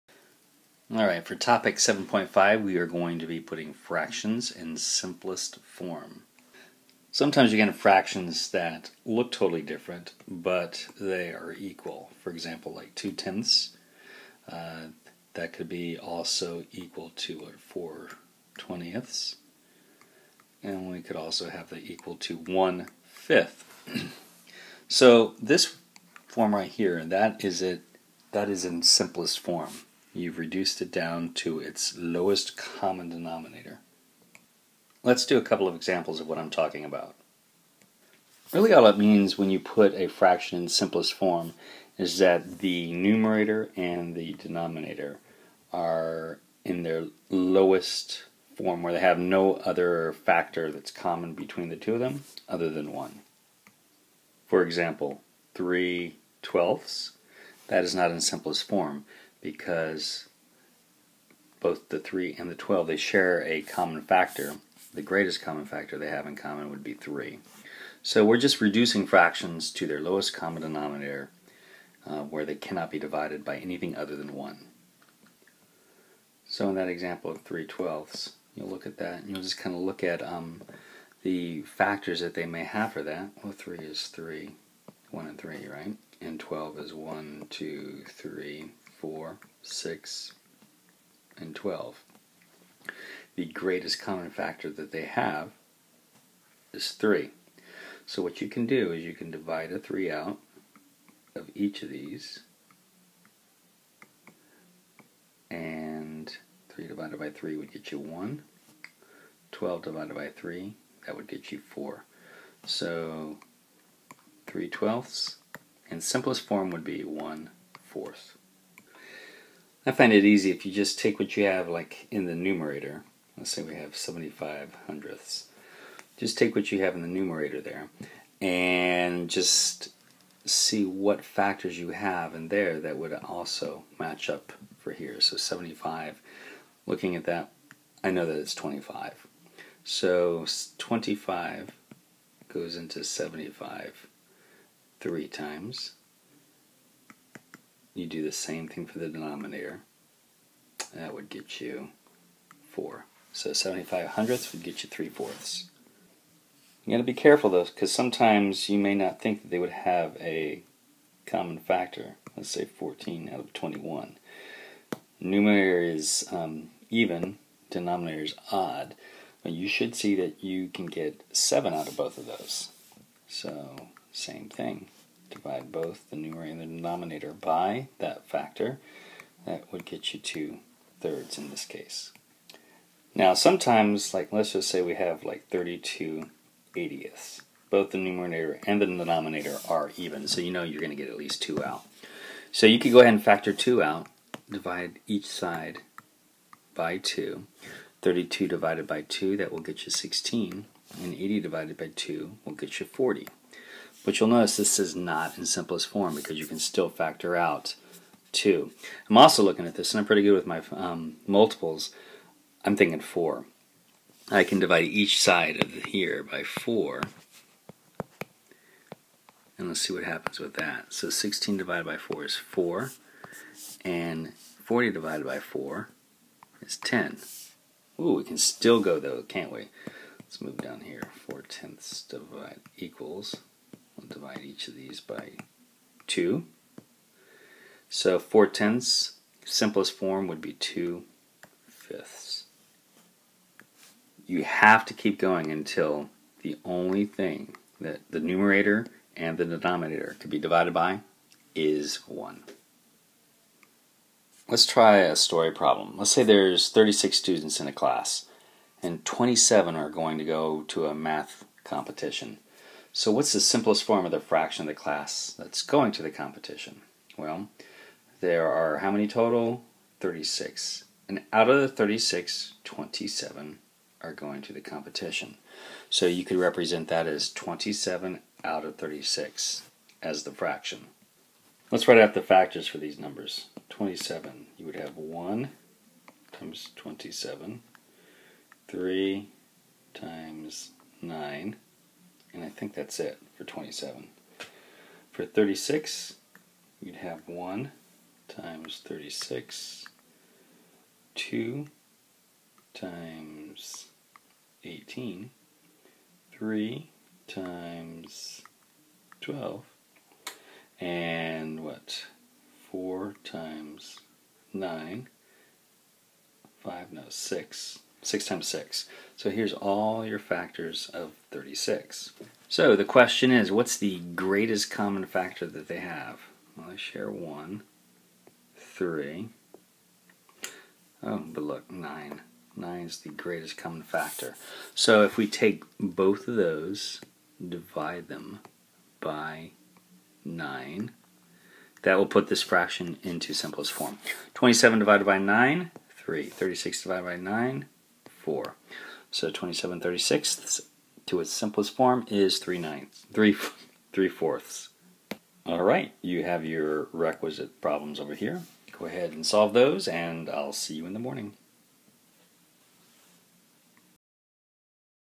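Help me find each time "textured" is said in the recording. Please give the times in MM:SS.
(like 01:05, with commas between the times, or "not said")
not said.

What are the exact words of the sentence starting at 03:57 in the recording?
So 4 tenths, simplest form would be 2 fifths.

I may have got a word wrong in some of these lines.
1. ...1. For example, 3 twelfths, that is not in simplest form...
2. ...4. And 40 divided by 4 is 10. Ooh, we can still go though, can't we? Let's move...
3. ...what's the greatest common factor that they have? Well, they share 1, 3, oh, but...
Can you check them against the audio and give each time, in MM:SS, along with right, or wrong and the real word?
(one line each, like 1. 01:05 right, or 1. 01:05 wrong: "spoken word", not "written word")
1. 00:52 right
2. 03:42 right
3. 05:23 right.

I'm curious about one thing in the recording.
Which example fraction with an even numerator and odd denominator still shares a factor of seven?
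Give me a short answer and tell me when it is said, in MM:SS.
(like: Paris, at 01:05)
14 out of 21, at 02:42.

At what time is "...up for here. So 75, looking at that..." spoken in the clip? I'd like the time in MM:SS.
02:14.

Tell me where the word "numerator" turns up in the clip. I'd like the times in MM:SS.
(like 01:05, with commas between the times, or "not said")
00:42, 02:02, 02:07, 02:45, 02:56, 03:07, 04:08.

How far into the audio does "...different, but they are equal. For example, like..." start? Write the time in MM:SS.
00:09.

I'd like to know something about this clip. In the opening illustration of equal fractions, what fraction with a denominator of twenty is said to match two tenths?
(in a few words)
4 twentieths.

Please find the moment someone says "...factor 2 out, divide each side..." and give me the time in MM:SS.
03:13.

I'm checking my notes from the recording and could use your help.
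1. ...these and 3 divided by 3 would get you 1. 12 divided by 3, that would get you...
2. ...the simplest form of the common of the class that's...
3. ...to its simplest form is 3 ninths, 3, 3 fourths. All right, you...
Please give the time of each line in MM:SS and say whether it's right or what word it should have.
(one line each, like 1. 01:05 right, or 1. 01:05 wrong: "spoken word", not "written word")
1. 01:41 right
2. 04:23 wrong: "fraction", not "common"
3. 05:51 right.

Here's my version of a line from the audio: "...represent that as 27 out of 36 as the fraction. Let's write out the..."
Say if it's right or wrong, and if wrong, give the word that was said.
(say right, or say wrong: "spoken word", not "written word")
right.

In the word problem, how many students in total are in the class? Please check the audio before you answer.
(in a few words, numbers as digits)
36.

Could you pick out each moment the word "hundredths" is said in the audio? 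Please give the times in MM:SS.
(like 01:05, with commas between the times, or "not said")
02:04, 02:34.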